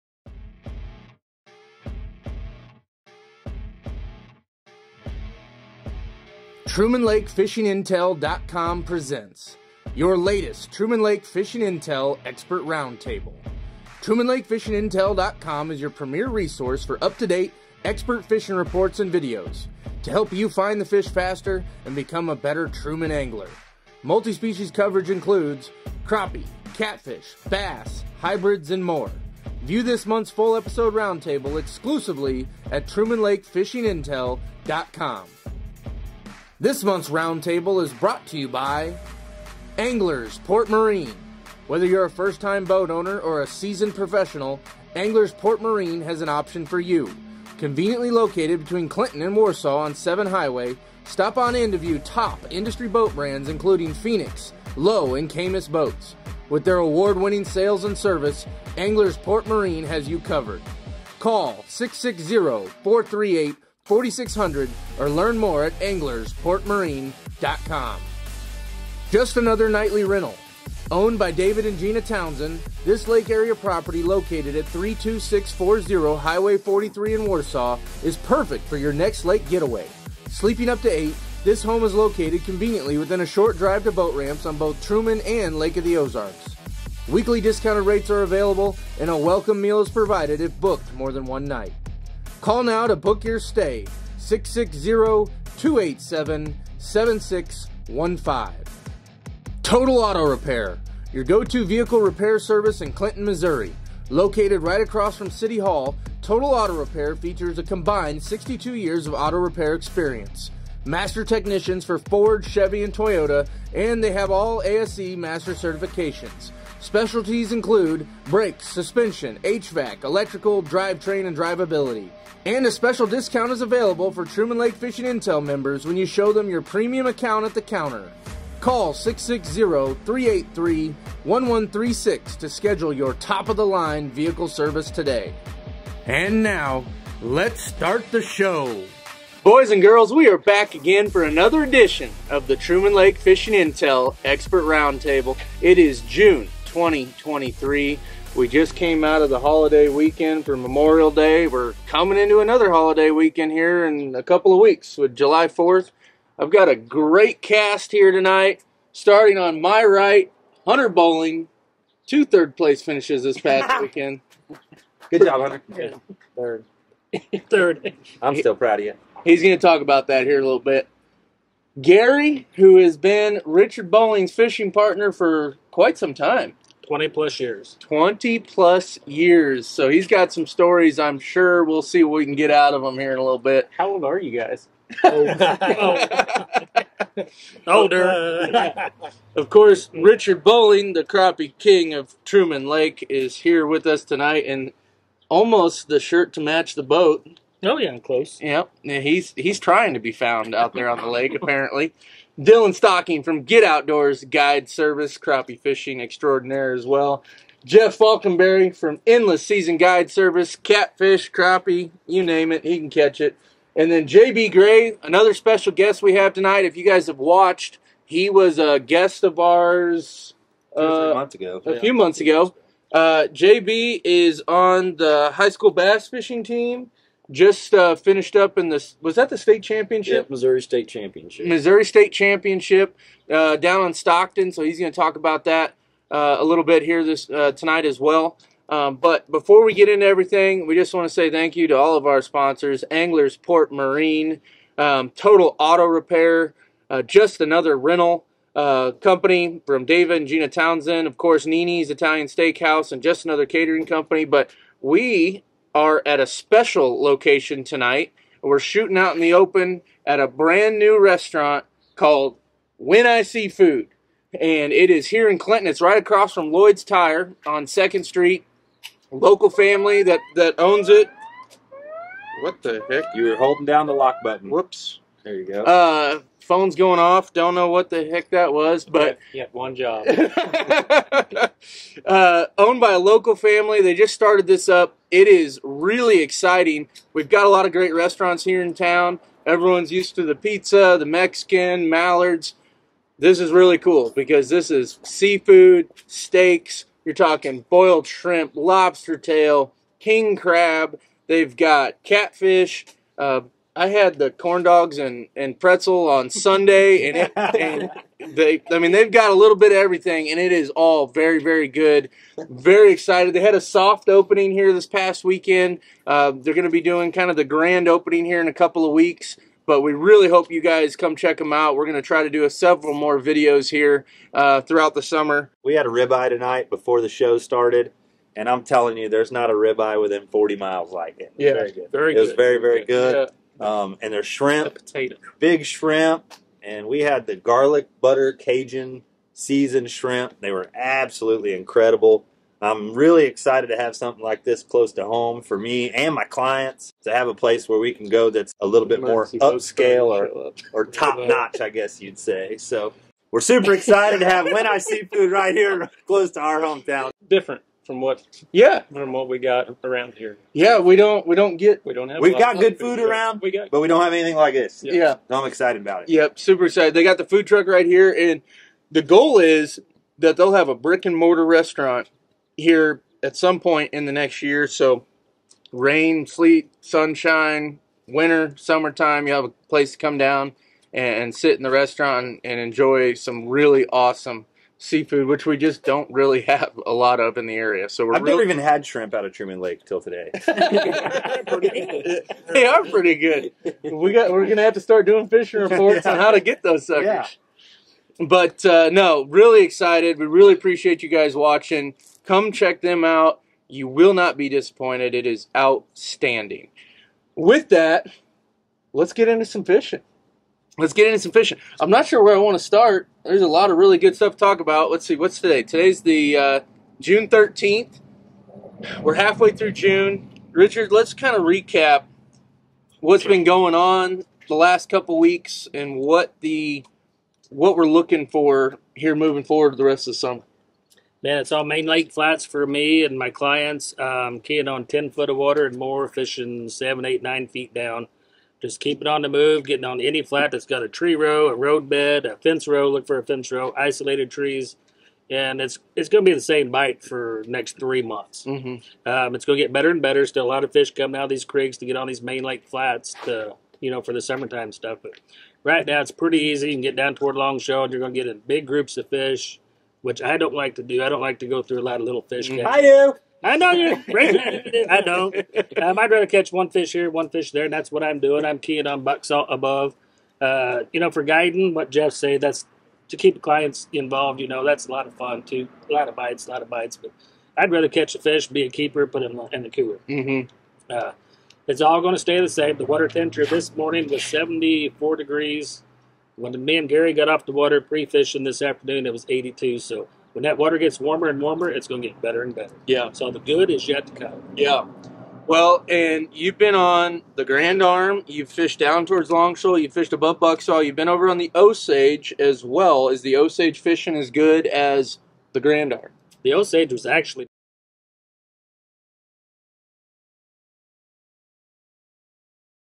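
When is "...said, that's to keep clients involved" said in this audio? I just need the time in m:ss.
7:52.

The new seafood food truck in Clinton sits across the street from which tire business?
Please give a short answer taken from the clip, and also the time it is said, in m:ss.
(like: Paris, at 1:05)
Lloyd's Tire, at 4:26.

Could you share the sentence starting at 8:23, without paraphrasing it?
Is the Osage fishing as good as the Grand Arm?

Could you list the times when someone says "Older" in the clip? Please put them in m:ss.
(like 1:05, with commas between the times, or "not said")
3:07.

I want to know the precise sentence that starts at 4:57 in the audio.
You're talking boiled shrimp, lobster tail, king crab.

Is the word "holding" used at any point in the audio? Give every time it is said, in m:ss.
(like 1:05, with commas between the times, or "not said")
4:33.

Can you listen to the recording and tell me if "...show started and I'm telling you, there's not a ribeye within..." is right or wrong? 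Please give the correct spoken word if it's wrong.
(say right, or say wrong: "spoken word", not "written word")
right.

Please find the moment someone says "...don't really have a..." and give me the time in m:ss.
6:25.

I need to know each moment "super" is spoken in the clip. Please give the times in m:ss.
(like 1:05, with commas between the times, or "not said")
5:53, 6:06.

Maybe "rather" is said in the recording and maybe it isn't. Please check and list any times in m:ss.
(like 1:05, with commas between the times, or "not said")
7:46, 7:57.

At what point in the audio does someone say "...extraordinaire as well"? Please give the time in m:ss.
3:26.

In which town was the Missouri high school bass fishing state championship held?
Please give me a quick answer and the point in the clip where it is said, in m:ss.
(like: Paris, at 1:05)
Stockton, at 3:53.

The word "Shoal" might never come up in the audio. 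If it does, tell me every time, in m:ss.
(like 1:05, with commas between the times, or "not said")
7:37, 8:19.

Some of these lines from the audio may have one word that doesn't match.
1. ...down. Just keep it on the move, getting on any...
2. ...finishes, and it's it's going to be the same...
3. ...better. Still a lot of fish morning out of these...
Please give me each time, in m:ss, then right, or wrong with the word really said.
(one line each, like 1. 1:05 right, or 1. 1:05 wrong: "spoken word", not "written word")
1. 7:17 right
2. 7:24 wrong: "trees", not "finishes"
3. 7:29 wrong: "coming", not "morning".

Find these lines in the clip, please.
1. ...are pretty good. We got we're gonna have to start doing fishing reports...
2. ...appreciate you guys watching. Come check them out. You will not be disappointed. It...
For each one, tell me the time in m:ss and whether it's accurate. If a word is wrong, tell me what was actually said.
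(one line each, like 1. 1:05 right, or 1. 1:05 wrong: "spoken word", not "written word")
1. 6:32 right
2. 6:40 right.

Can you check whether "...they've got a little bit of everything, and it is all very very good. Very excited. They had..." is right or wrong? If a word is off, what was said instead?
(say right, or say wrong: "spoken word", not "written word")
right.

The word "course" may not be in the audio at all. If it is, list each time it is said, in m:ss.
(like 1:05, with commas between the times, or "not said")
3:09, 4:11.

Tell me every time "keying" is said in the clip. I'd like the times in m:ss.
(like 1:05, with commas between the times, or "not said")
7:14, 7:48.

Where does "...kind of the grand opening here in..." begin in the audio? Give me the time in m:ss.
5:17.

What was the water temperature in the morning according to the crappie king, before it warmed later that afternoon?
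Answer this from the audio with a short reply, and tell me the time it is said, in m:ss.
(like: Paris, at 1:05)
74 degrees, at 8:04.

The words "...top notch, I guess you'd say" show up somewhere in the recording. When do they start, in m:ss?
5:50.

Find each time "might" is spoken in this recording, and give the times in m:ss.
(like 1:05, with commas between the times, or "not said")
7:45.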